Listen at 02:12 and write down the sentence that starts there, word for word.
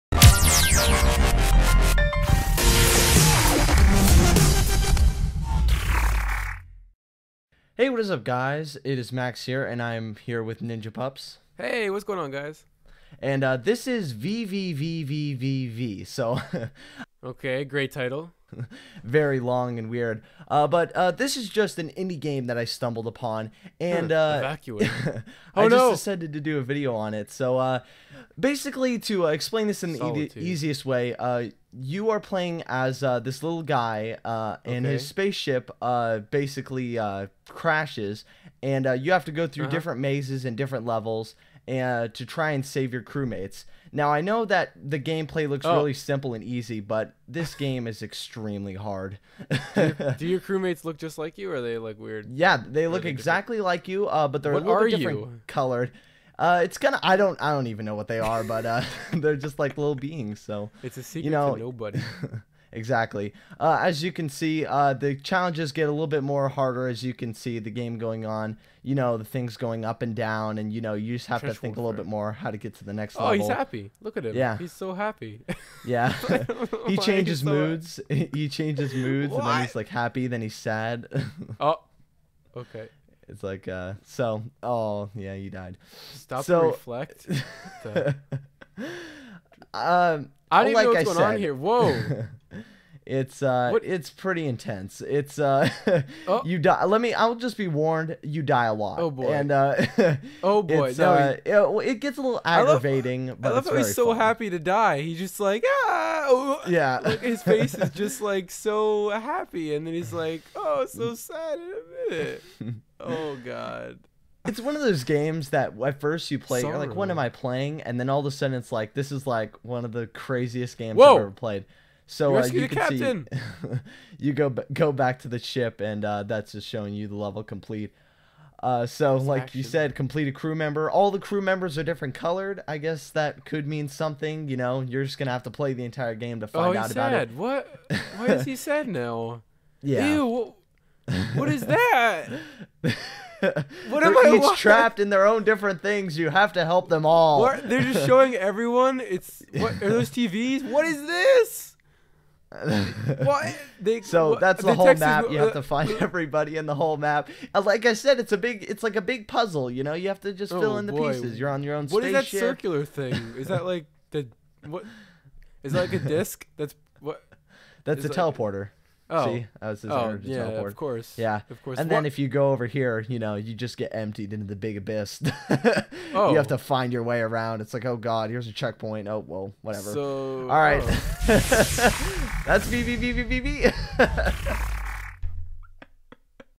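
I guess that could mean something.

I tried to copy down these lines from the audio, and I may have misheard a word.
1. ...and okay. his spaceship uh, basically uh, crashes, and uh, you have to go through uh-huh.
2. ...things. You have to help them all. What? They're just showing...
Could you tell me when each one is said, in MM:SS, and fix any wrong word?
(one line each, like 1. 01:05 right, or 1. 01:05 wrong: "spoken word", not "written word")
1. 00:34 right
2. 02:25 right.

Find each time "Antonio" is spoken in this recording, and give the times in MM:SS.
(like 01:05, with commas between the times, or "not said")
not said.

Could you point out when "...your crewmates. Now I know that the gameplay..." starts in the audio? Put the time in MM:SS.
00:42.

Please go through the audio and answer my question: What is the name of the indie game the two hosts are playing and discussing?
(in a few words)
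VVVVVV.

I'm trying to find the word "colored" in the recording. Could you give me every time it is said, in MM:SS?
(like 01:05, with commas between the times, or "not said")
00:55, 02:12.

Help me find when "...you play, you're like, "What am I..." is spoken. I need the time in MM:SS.
01:56.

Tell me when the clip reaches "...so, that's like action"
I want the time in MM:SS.
02:08.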